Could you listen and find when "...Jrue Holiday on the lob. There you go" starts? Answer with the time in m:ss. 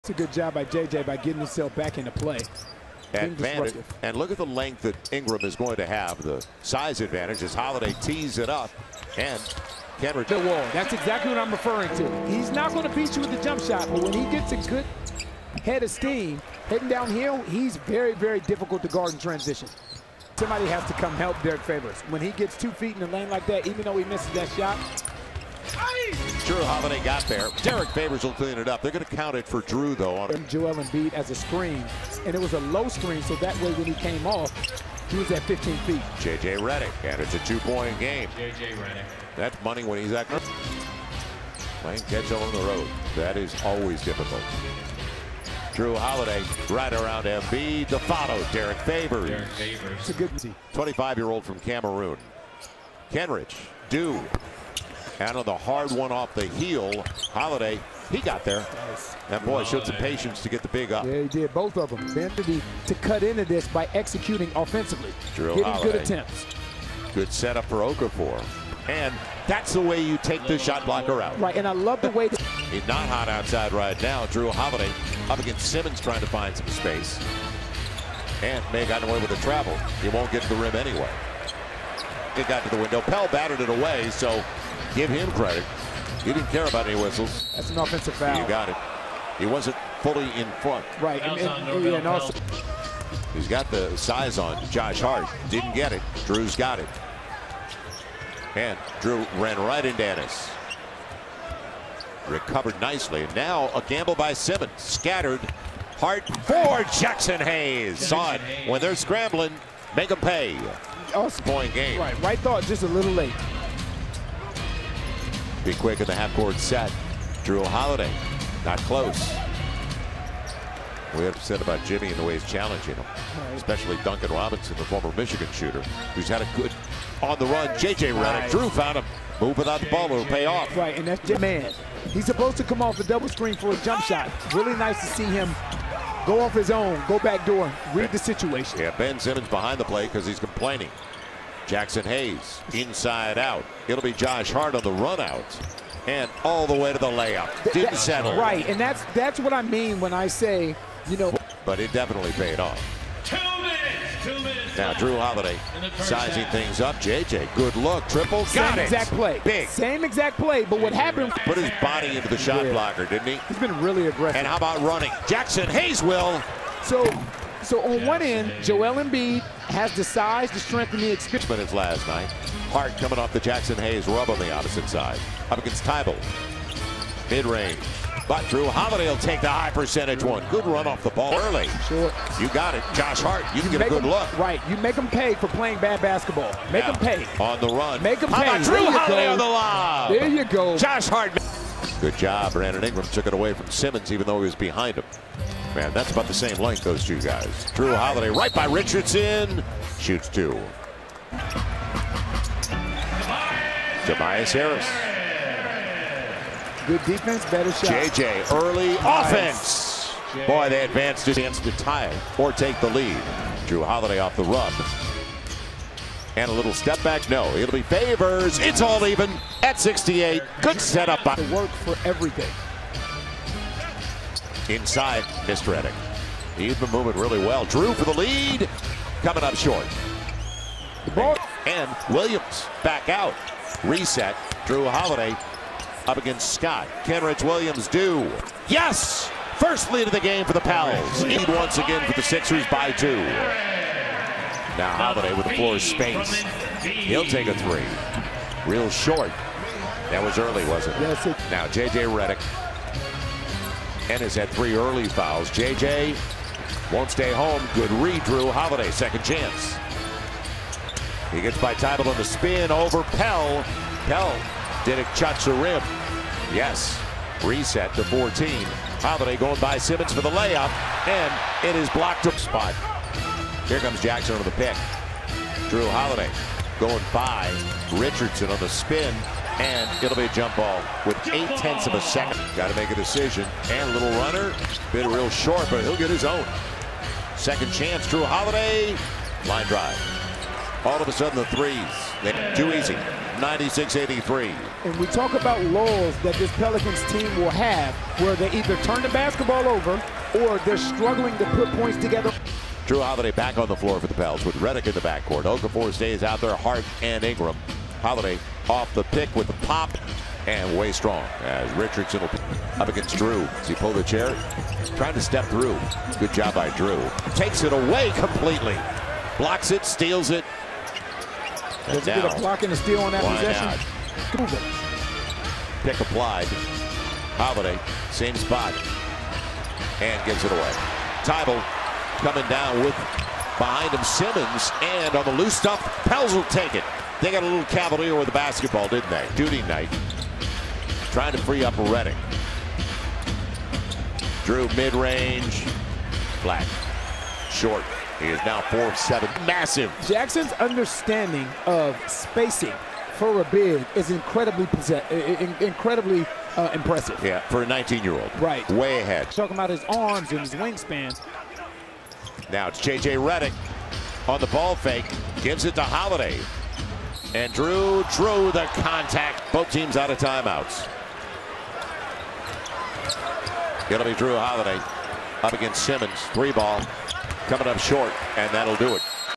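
3:08.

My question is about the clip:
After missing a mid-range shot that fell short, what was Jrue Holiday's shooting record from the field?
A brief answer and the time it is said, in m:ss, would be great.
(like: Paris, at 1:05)
4-7, at 5:48.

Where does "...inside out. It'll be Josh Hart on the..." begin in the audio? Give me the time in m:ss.
2:22.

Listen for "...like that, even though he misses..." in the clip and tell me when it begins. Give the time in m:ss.
0:23.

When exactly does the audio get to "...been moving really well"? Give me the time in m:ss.
3:46.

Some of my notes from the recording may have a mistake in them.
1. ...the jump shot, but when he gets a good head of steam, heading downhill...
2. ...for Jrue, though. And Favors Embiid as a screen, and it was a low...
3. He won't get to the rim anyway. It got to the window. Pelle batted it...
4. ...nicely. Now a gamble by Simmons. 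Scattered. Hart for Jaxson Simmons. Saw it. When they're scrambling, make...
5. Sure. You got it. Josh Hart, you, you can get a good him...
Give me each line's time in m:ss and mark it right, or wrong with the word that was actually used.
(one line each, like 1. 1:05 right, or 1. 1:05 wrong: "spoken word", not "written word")
1. 0:13 right
2. 0:29 wrong: "Joel", not "Favors"
3. 1:20 right
4. 1:42 wrong: "Hayes", not "Simmons"
5. 3:01 right.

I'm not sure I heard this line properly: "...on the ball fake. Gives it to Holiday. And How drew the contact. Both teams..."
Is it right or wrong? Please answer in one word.
wrong.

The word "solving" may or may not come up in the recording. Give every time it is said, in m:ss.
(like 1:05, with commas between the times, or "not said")
not said.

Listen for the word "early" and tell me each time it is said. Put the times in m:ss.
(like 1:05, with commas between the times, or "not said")
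3:01, 3:28, 4:10, 4:14.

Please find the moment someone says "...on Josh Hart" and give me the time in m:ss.
1:34.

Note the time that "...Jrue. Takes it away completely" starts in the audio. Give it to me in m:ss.
5:16.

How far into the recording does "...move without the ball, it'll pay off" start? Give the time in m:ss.
2:09.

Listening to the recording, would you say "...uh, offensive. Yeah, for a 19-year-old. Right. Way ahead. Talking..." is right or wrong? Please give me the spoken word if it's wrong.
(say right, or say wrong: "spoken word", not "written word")
wrong: "impressive", not "offensive".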